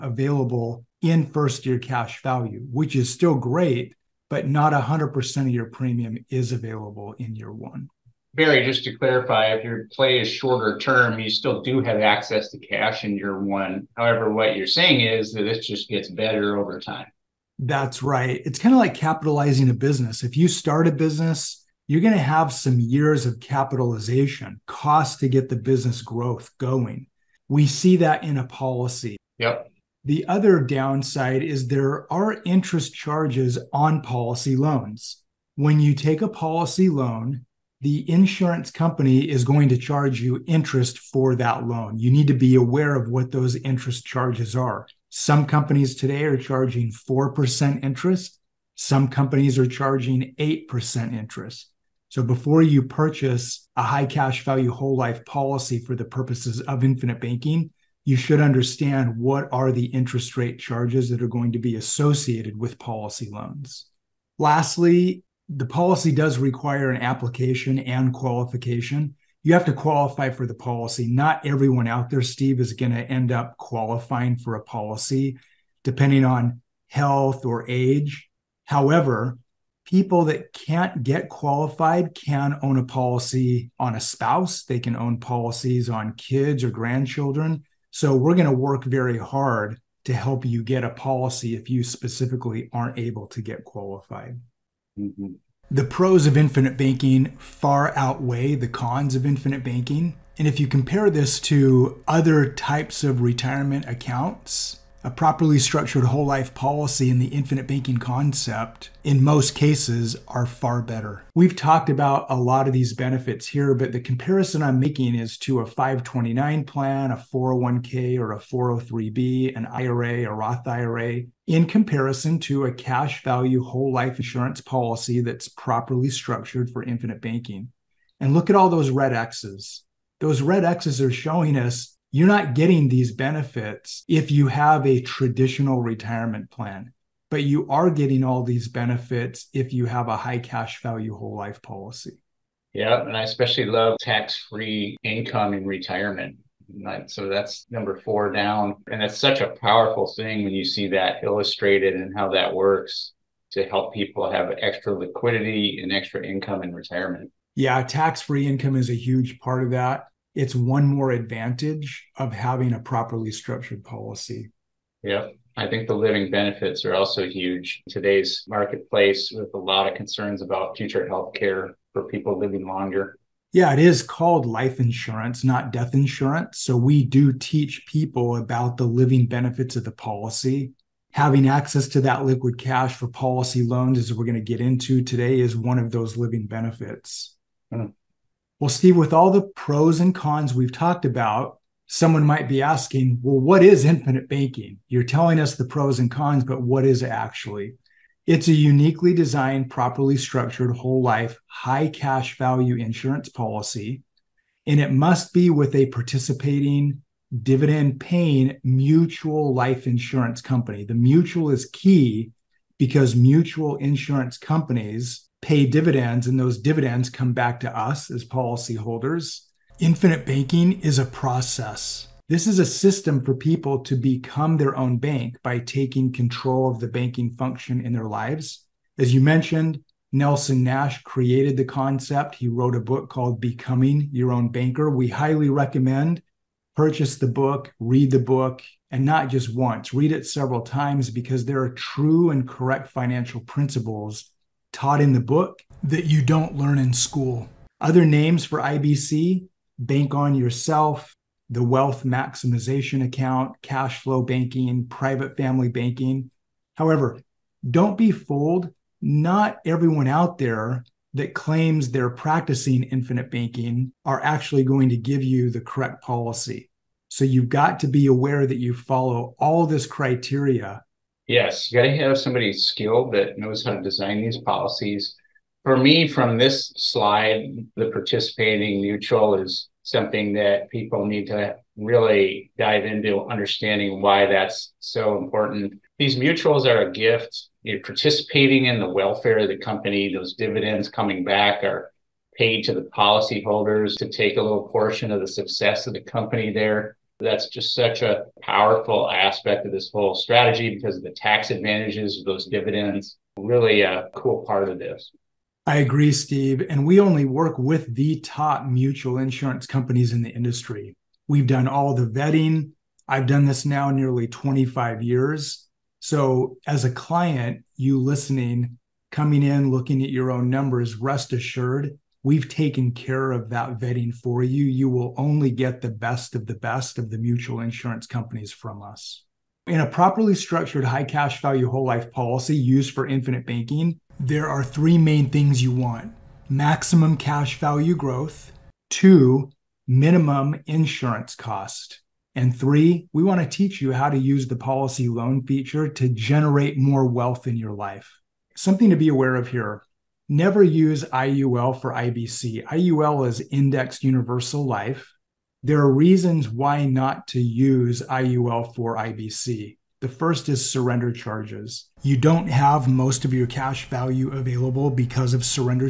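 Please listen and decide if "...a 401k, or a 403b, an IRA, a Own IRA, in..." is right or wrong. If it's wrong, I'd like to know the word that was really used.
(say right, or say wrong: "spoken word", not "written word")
wrong: "Roth", not "Own".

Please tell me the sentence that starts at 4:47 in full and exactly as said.
You're participating in the welfare of the company.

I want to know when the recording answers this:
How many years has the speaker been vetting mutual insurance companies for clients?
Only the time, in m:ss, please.
5:13.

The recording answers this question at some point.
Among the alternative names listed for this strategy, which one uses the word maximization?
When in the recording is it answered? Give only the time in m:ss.
4:11.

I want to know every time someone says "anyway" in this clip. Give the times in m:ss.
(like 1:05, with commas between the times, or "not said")
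not said.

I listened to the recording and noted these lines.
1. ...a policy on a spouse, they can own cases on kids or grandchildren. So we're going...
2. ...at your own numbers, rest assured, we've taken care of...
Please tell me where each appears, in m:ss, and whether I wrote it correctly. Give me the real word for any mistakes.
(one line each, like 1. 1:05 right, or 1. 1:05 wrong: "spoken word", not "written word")
1. 1:22 wrong: "policies", not "cases"
2. 5:20 right.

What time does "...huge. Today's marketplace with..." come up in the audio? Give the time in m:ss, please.
2:47.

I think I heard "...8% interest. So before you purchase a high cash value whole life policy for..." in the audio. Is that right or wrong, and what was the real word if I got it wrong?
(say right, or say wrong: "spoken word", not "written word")
right.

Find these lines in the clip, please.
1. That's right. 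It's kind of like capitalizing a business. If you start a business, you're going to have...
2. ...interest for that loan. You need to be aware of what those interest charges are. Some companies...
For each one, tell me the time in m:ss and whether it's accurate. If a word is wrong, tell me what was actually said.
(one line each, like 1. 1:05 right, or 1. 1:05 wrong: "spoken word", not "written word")
1. 0:17 right
2. 0:40 right.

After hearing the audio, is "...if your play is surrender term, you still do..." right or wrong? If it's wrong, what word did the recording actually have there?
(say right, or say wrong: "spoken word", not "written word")
wrong: "shorter", not "surrender".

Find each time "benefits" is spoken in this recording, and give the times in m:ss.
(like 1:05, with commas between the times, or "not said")
1:52, 2:13, 2:18, 2:46, 2:59, 3:06.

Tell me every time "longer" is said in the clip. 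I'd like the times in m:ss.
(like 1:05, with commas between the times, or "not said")
2:52.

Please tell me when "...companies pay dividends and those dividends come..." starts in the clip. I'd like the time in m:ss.
3:34.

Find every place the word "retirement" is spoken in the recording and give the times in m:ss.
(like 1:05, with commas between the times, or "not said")
1:43, 2:15, 2:25, 2:36.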